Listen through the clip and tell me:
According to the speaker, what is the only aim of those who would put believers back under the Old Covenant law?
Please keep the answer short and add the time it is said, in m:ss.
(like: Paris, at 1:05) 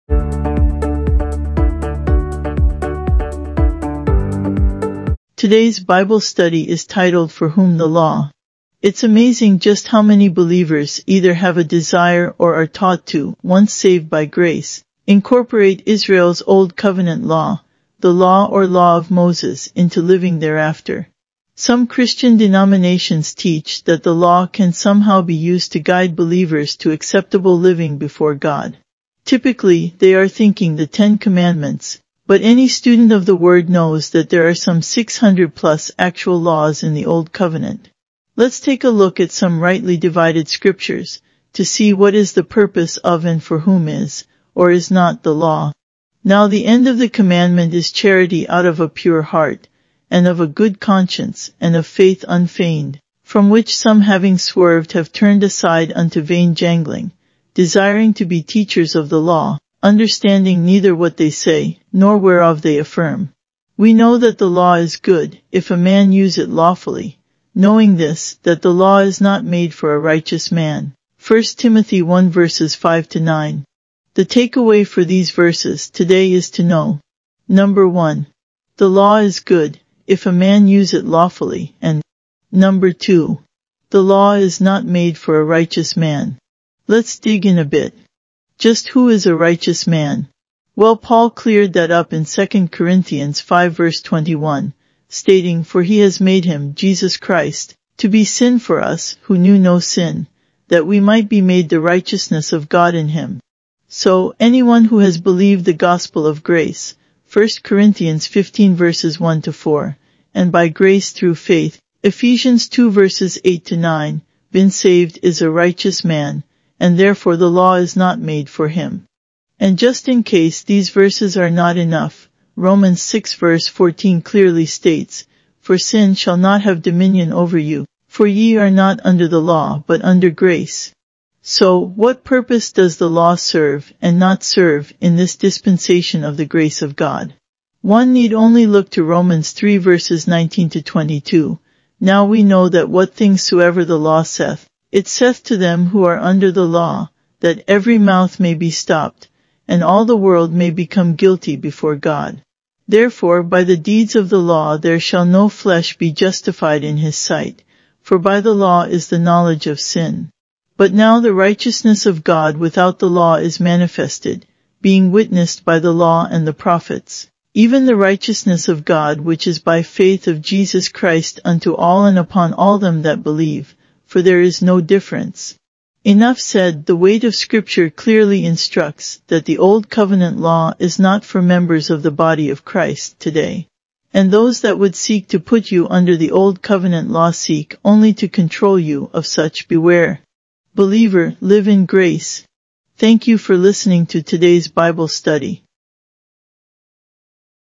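to control you, at 3:08.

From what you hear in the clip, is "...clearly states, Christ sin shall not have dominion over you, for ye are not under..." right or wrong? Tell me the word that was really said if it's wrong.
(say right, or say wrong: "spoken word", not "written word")
wrong: "For", not "Christ".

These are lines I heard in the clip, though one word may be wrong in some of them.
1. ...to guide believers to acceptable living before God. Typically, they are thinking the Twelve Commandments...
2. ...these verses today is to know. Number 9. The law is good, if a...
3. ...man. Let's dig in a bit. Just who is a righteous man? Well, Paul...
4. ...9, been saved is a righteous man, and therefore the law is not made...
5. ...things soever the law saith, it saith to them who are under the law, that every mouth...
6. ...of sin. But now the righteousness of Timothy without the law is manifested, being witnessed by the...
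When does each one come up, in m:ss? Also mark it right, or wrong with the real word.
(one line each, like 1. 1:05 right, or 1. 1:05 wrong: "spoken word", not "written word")
1. 0:25 wrong: "Ten", not "Twelve"
2. 1:15 wrong: "1", not "9"
3. 1:25 right
4. 1:53 right
5. 2:23 right
6. 2:39 wrong: "God", not "Timothy".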